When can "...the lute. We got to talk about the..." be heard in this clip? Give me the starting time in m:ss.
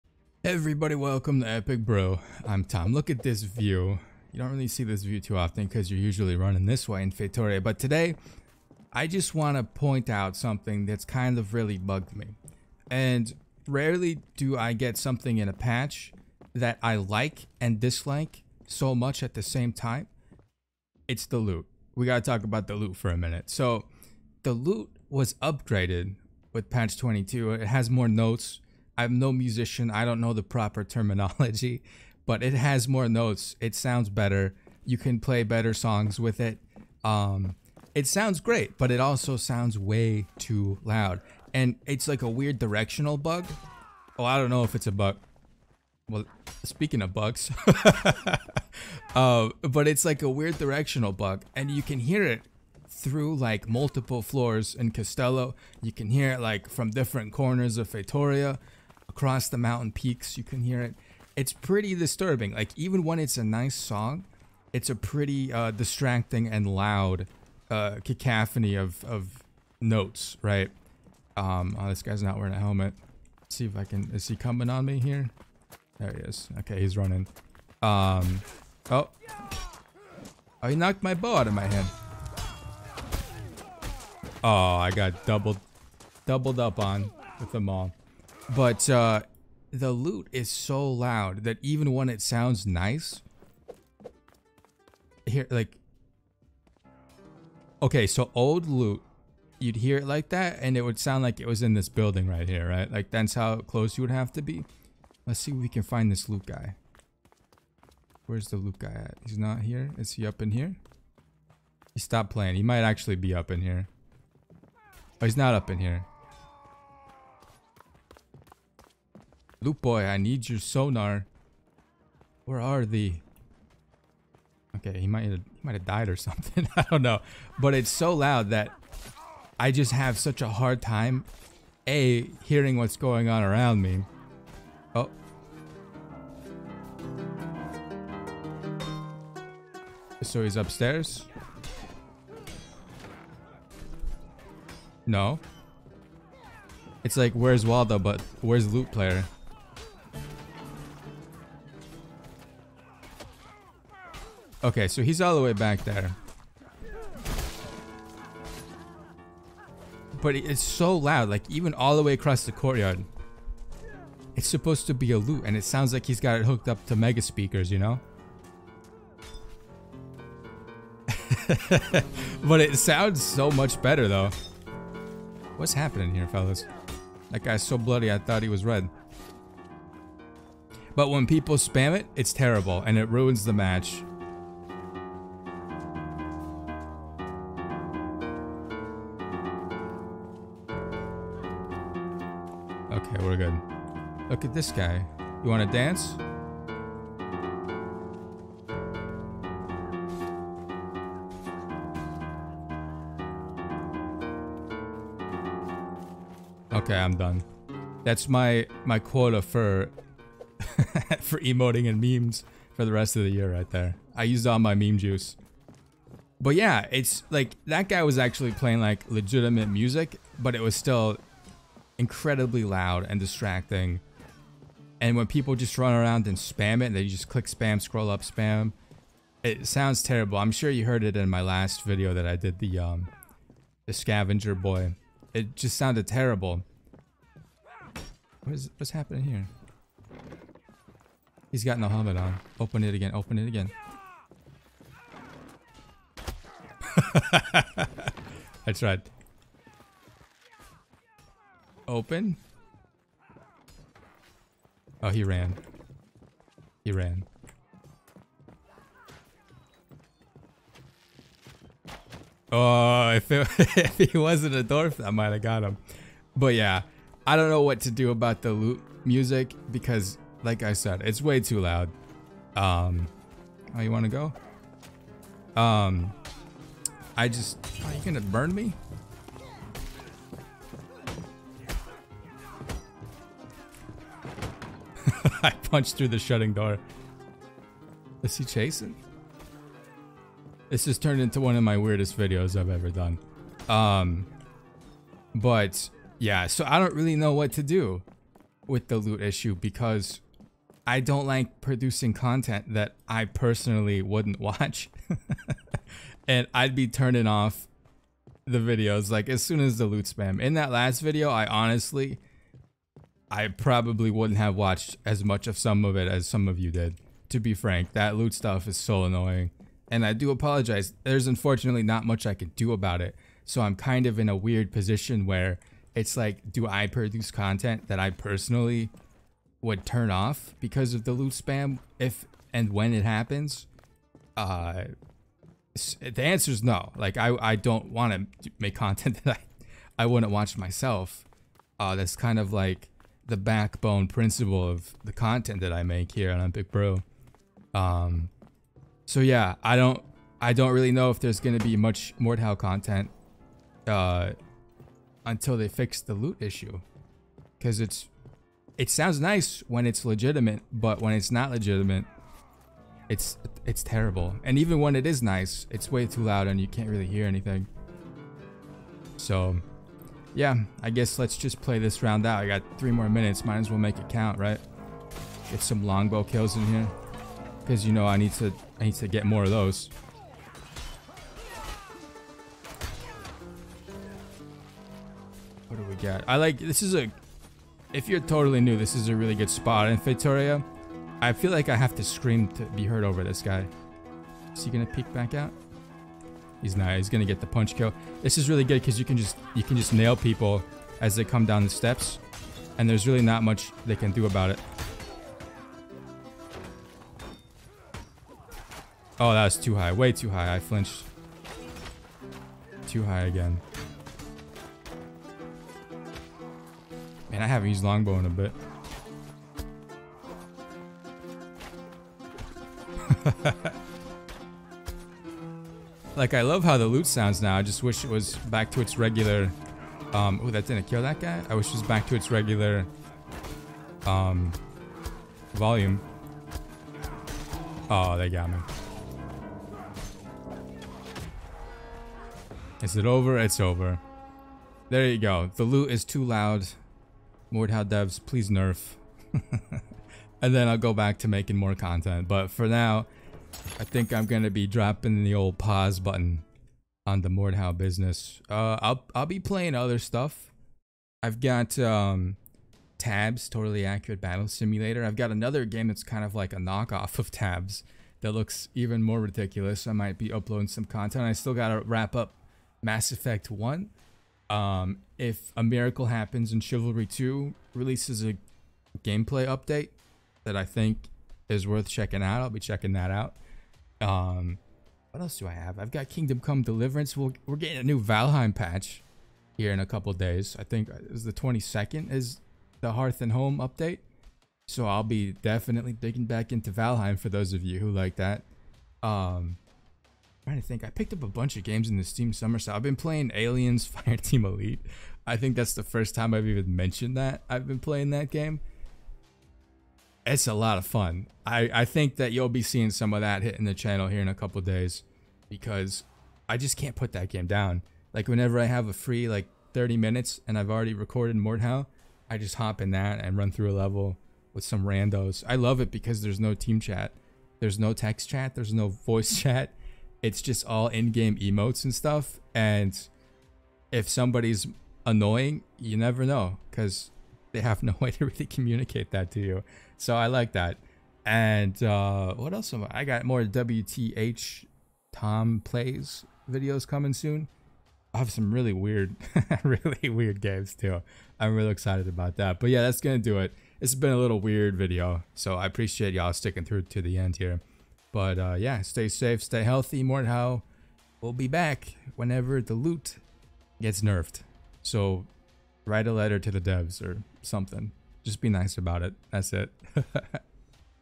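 0:21.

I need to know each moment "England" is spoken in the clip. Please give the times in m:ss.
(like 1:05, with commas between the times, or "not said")
not said.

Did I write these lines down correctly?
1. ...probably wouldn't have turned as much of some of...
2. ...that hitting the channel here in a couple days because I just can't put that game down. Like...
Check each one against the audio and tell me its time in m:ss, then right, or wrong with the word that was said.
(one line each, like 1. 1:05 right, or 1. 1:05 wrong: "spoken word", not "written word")
1. 5:13 wrong: "watched", not "turned"
2. 8:33 right.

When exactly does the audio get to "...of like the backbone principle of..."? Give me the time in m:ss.
5:42.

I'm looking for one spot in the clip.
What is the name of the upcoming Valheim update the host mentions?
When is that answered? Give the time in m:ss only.
8:12.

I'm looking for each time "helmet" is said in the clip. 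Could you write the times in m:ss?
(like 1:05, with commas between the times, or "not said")
1:12, 4:01.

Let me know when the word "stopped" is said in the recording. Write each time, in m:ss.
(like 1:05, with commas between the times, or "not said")
1:52.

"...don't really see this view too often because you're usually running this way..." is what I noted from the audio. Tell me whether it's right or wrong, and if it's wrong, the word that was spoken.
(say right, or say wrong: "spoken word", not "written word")
right.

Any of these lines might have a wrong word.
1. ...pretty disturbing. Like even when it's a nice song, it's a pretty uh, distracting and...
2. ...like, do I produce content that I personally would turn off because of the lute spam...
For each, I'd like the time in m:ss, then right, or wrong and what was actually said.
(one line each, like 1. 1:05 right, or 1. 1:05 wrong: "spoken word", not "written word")
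1. 1:01 right
2. 5:26 right.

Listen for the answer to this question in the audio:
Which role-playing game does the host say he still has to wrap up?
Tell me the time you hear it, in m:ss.
7:52.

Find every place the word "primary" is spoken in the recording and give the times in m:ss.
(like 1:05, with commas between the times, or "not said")
not said.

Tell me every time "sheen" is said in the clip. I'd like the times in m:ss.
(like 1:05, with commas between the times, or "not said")
not said.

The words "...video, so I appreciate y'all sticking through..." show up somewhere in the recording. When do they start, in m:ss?
9:14.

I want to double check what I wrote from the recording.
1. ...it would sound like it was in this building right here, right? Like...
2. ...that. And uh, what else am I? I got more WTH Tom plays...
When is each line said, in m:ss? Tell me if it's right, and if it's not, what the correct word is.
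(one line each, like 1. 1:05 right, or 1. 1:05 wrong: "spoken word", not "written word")
1. 1:40 right
2. 9:00 right.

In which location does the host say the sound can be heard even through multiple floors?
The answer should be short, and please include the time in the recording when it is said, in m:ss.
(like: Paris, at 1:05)
Castello, at 0:54.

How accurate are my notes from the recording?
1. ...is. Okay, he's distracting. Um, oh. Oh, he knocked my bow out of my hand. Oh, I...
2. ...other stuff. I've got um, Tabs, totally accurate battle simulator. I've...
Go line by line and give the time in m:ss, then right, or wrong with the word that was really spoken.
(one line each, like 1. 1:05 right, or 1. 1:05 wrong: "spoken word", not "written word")
1. 1:16 wrong: "running", not "distracting"
2. 7:39 right.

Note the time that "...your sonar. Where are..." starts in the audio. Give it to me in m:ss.
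2:00.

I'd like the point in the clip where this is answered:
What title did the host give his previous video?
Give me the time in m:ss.
3:53.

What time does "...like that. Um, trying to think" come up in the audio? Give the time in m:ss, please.
8:17.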